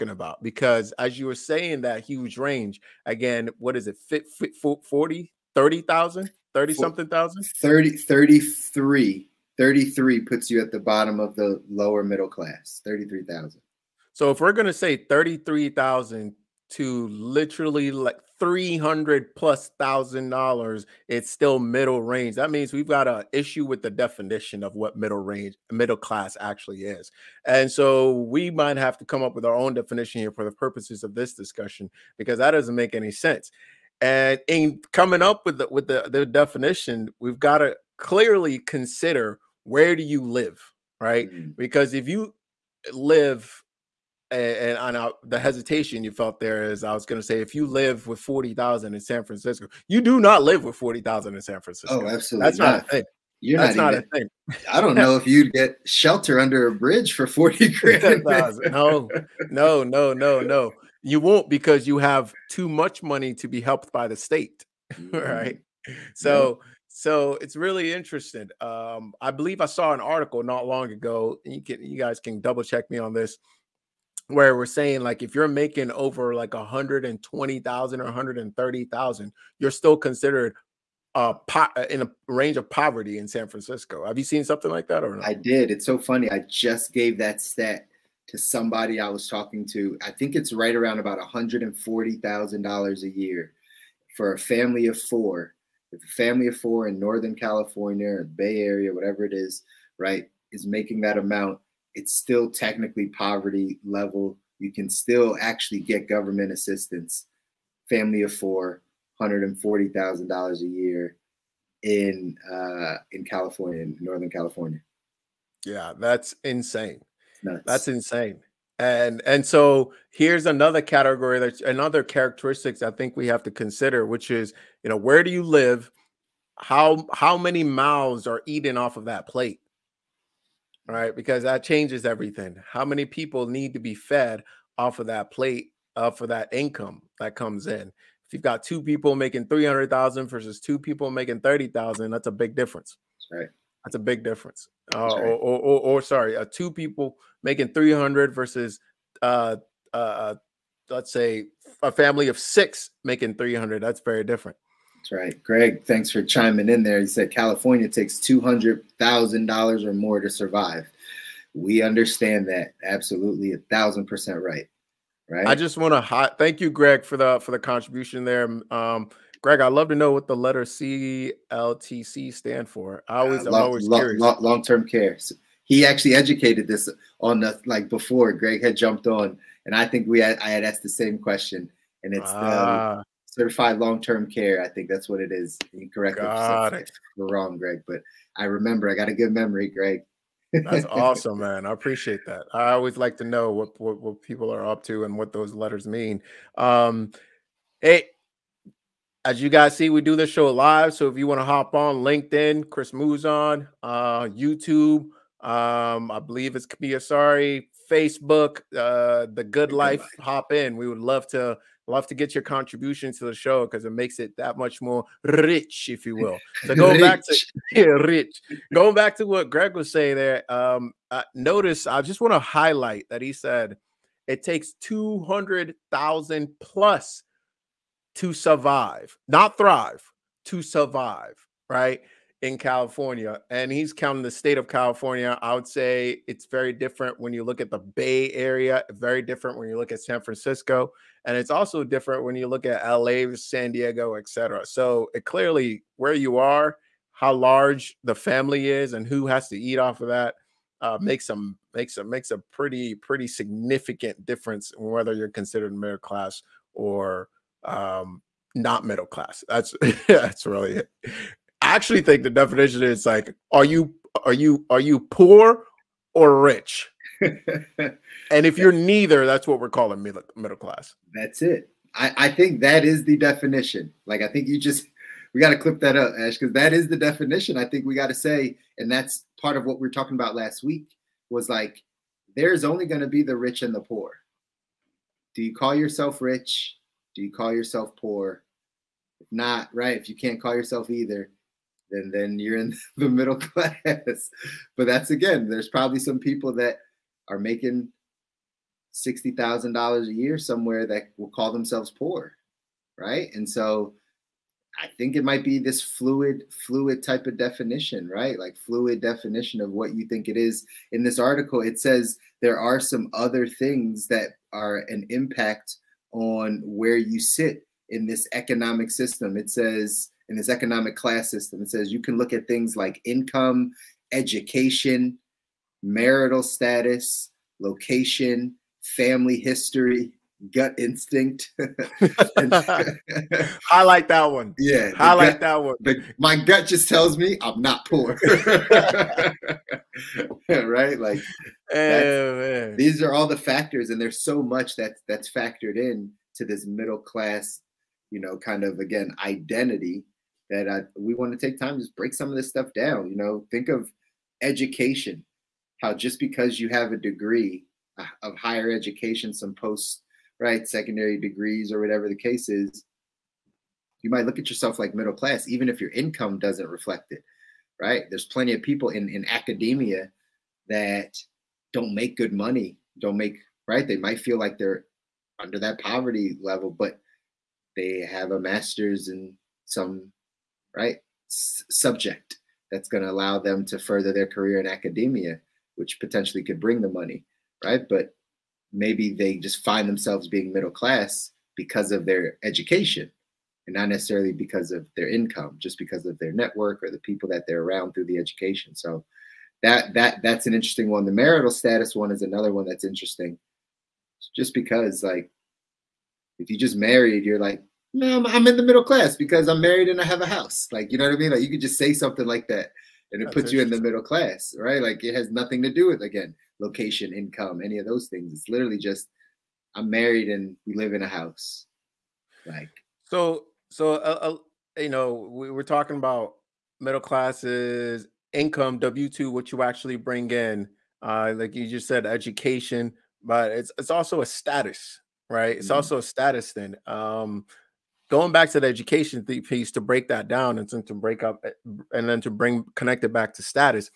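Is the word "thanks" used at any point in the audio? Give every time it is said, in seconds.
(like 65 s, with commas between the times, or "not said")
155 s, 166 s.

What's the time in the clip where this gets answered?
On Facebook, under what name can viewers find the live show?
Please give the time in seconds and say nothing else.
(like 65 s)
209 s.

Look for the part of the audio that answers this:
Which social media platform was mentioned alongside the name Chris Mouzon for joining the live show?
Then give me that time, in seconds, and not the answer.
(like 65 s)
201 s.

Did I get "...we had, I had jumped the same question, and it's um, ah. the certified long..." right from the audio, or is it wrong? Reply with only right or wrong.
wrong.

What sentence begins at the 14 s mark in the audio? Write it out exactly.
So if we're going to say 33,000 to literally like 300 plus thousand dollars, it's still middle range.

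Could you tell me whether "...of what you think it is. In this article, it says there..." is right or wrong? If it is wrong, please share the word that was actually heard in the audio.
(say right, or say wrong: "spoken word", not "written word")
right.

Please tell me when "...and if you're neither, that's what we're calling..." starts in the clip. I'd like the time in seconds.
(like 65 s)
267 s.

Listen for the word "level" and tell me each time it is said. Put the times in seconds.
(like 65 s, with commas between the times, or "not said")
103 s, 376 s.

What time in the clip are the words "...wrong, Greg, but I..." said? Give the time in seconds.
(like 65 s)
187 s.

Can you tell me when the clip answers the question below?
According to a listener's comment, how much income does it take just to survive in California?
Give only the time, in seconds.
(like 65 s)
158 s.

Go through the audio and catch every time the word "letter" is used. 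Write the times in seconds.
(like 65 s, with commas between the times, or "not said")
170 s, 195 s.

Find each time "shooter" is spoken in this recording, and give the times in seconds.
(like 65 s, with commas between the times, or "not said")
not said.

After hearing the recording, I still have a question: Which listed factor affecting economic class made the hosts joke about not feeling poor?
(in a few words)
gut instinct.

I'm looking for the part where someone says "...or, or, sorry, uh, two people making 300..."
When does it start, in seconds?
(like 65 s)
145 s.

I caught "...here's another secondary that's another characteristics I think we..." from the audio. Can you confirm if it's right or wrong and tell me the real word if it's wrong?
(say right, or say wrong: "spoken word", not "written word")
wrong: "category", not "secondary".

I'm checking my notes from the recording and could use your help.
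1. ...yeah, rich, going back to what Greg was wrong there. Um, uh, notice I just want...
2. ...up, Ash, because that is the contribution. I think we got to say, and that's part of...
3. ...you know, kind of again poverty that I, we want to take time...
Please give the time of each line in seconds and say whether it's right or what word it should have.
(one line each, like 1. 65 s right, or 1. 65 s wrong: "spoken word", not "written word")
1. 217 s wrong: "saying", not "wrong"
2. 275 s wrong: "definition", not "contribution"
3. 348 s wrong: "identity", not "poverty".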